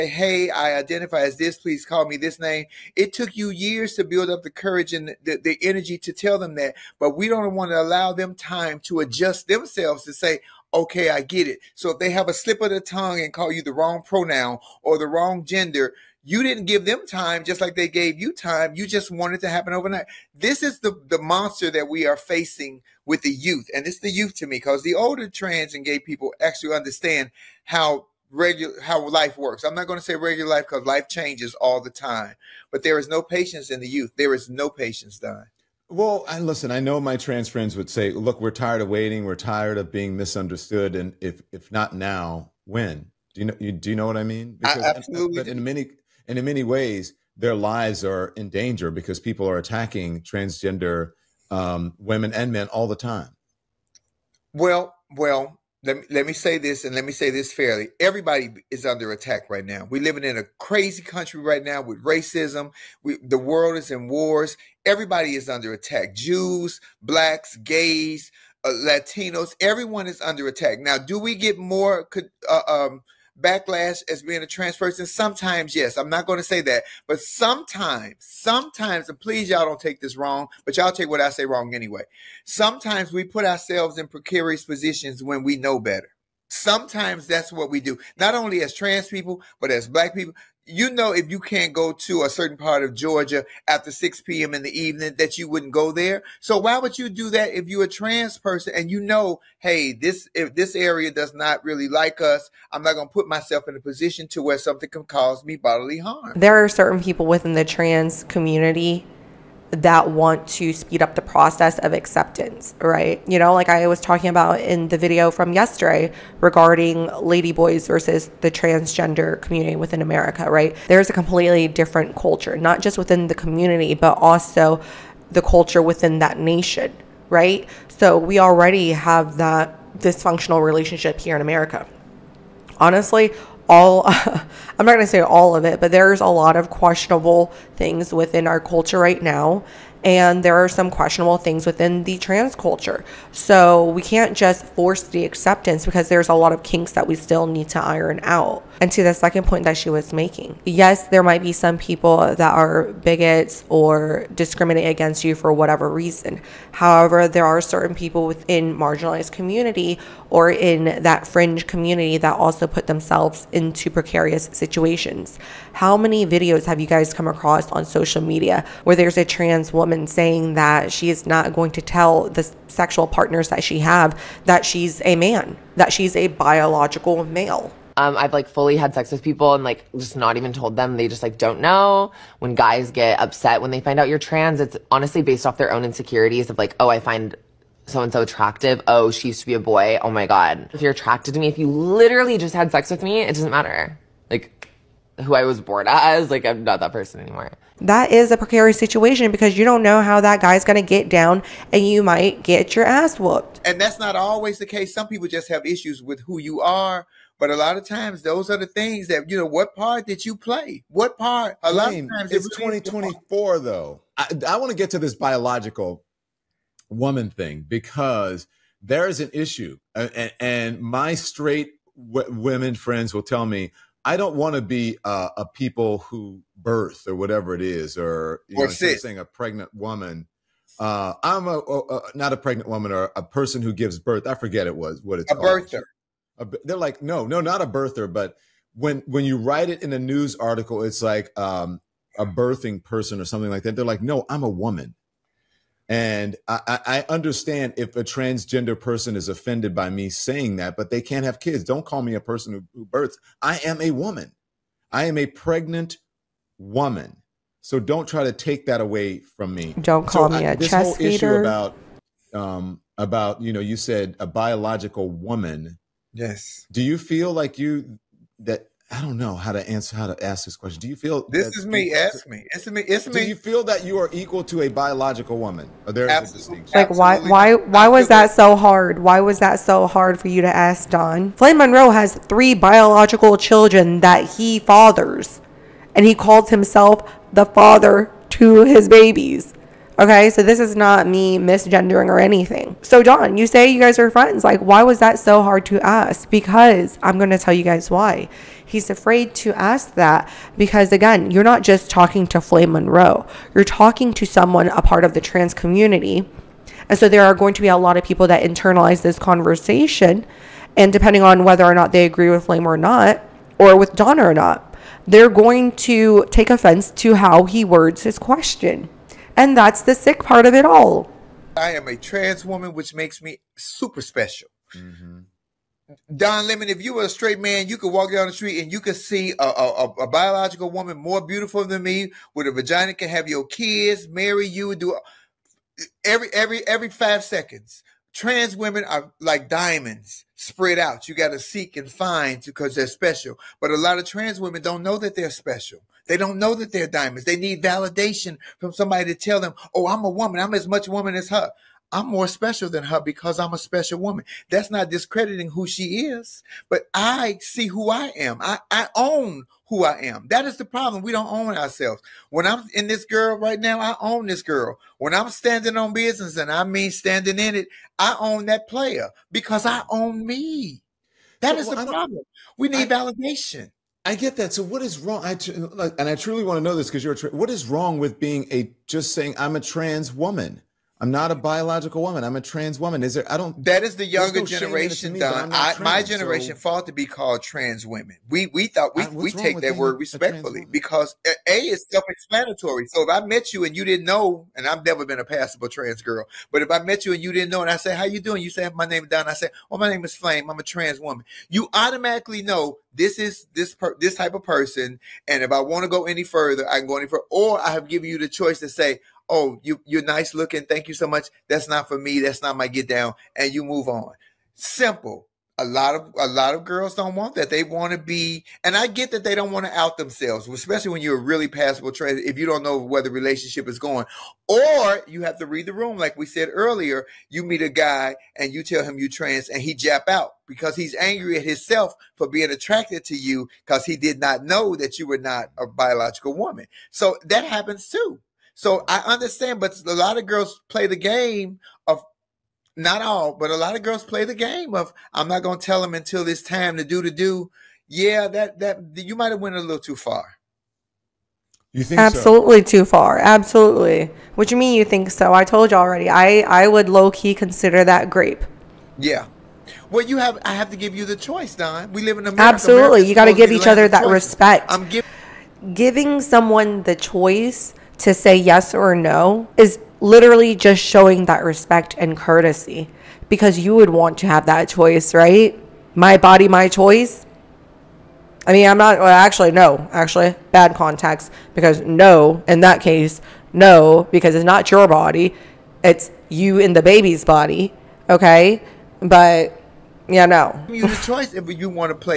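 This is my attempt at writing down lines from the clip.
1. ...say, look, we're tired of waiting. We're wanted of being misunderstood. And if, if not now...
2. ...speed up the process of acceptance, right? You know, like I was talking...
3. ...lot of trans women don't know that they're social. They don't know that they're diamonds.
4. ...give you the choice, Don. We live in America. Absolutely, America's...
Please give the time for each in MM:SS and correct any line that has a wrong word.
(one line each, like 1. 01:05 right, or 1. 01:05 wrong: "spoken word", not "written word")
1. 00:37 wrong: "tired", not "wanted"
2. 01:50 right
3. 05:43 wrong: "special", not "social"
4. 07:40 right.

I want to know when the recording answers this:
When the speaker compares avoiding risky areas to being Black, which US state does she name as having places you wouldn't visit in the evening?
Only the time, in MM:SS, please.
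01:32.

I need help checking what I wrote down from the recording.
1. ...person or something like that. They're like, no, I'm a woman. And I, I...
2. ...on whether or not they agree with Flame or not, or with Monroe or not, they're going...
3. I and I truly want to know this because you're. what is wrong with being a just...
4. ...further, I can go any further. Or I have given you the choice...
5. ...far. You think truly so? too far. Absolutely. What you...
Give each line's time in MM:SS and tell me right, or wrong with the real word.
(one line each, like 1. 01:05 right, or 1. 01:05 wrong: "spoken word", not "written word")
1. 04:02 right
2. 05:11 wrong: "Donna", not "Monroe"
3. 06:15 right
4. 06:46 right
5. 07:29 wrong: "absolutely", not "truly".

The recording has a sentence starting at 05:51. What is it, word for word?
I'm more special than her because I'm a special woman.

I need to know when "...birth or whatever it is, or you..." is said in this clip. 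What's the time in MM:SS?
03:46.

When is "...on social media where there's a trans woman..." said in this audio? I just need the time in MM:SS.
02:47.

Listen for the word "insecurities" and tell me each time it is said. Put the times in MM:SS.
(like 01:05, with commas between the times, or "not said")
03:05.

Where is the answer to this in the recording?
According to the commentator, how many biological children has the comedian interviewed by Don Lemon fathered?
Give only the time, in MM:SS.
04:42.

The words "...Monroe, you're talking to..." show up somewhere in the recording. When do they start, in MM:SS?
05:02.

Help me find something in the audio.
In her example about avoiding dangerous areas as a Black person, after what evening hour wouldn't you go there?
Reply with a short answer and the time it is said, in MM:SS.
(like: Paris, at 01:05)
6 p.m., at 01:33.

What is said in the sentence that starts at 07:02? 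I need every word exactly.
If you don't know where the relationship is going, or you have to read the room, like we said earlier.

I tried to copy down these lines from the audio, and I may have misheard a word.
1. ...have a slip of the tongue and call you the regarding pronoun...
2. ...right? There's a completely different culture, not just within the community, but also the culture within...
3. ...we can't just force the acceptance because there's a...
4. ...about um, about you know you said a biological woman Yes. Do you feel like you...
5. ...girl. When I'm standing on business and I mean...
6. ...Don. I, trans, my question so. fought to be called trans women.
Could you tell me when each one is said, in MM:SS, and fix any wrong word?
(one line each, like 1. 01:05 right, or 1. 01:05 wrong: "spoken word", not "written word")
1. 00:12 wrong: "wrong", not "regarding"
2. 02:00 right
3. 02:23 right
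4. 04:21 right
5. 06:04 right
6. 06:25 wrong: "generation", not "question".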